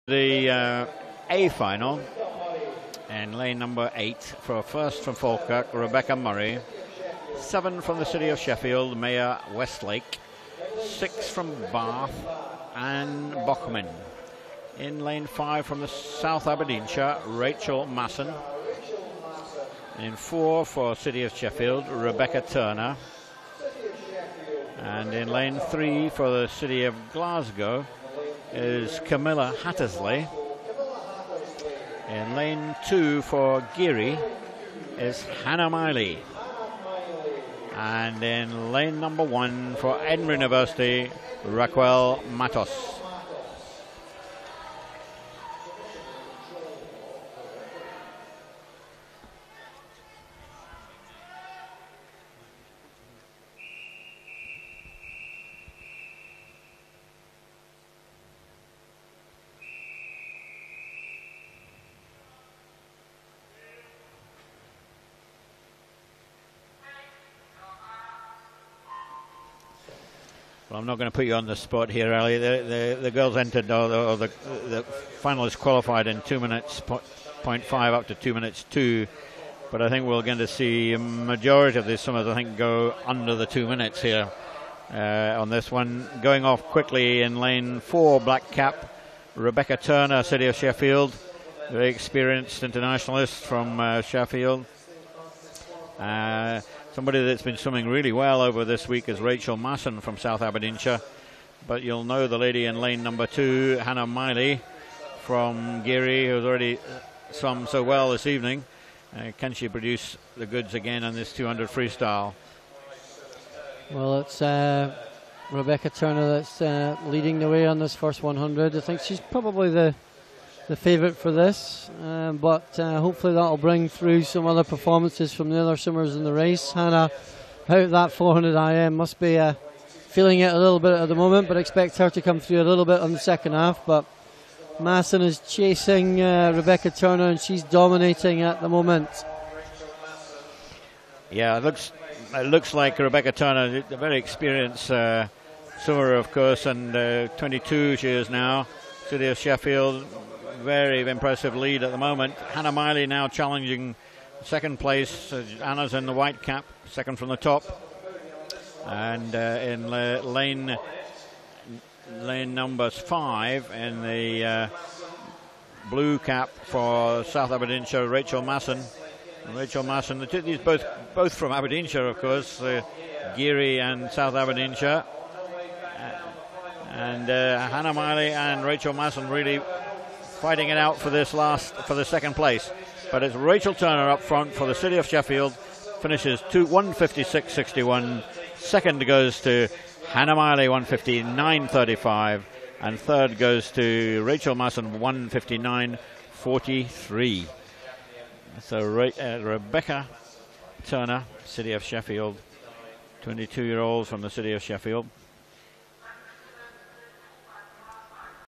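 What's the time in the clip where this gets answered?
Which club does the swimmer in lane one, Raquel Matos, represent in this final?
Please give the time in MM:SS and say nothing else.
00:40.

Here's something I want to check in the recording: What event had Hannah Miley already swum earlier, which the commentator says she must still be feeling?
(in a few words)
400 IM.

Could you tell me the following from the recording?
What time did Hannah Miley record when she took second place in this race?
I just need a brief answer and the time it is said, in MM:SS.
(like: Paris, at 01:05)
1:59.35, at 03:10.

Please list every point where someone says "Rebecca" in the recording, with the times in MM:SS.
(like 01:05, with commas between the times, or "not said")
00:05, 00:21, 01:29, 01:55, 02:16, 02:22, 03:19.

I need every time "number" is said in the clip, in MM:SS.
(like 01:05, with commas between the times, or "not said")
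00:03, 00:38, 01:43, 02:42.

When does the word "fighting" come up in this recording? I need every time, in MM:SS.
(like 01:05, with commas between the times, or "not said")
03:00.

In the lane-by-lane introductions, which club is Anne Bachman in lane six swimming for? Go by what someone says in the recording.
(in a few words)
Bath.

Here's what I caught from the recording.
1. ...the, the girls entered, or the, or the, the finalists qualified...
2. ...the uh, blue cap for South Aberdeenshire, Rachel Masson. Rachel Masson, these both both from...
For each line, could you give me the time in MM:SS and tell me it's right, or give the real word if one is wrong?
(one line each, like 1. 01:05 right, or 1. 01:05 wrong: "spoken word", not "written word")
1. 01:12 right
2. 02:44 right.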